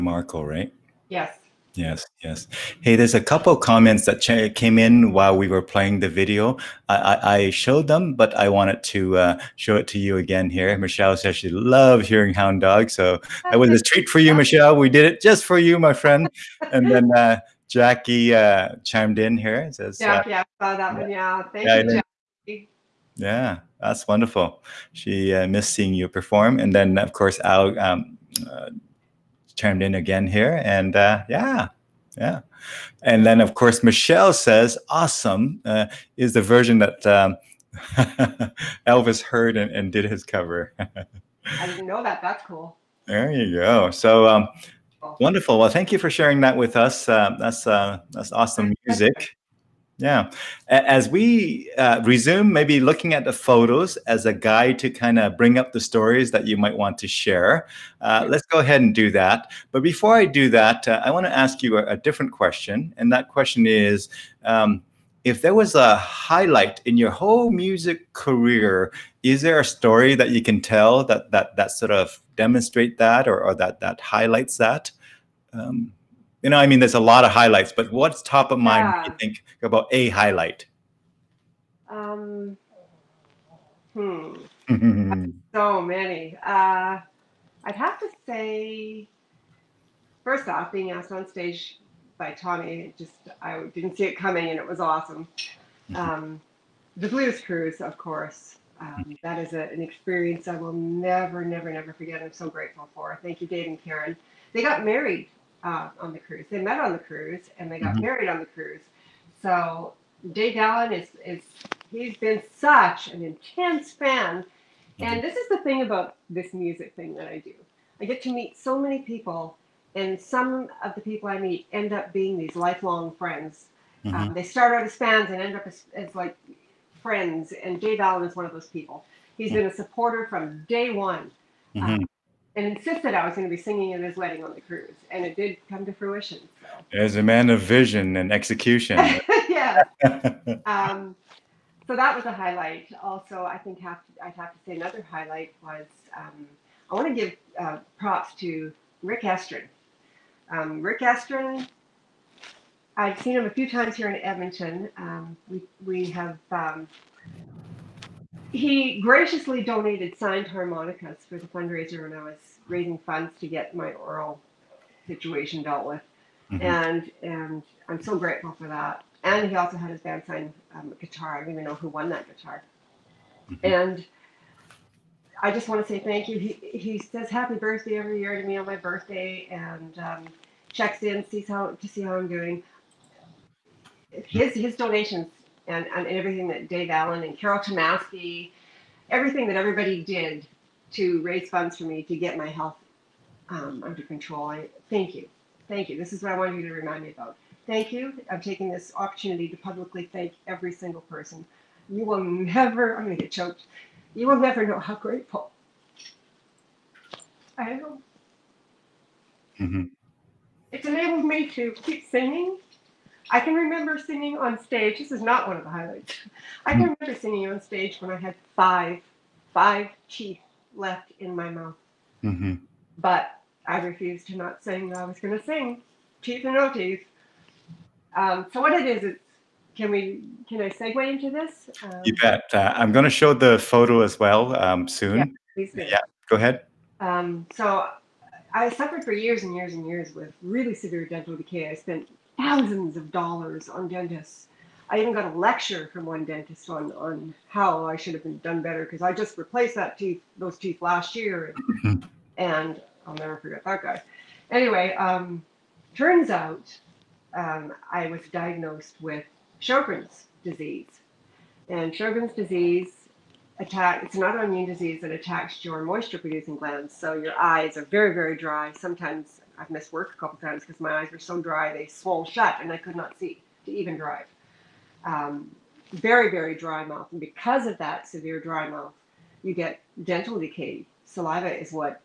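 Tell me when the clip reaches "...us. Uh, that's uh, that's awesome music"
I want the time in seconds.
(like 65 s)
46 s.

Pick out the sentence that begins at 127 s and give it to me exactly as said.
And Dave Allen is one of those people.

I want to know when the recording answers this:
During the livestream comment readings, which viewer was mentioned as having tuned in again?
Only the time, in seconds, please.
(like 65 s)
27 s.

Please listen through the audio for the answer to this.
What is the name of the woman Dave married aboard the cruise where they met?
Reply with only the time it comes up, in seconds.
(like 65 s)
103 s.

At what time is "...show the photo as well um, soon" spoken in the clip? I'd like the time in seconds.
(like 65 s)
233 s.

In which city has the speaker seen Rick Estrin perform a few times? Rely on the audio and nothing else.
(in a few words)
Edmonton.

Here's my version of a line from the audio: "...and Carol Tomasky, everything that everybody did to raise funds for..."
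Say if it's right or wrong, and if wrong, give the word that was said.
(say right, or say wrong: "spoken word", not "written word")
right.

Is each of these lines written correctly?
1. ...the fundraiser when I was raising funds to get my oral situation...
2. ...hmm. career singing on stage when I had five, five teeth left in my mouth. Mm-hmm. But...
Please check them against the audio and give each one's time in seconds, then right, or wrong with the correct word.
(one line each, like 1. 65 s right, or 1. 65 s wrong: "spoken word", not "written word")
1. 161 s right
2. 216 s wrong: "remember", not "career".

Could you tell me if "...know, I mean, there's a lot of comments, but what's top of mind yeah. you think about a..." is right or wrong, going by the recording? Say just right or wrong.
wrong.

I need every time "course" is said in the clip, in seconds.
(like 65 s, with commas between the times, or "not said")
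27 s, 33 s, 97 s.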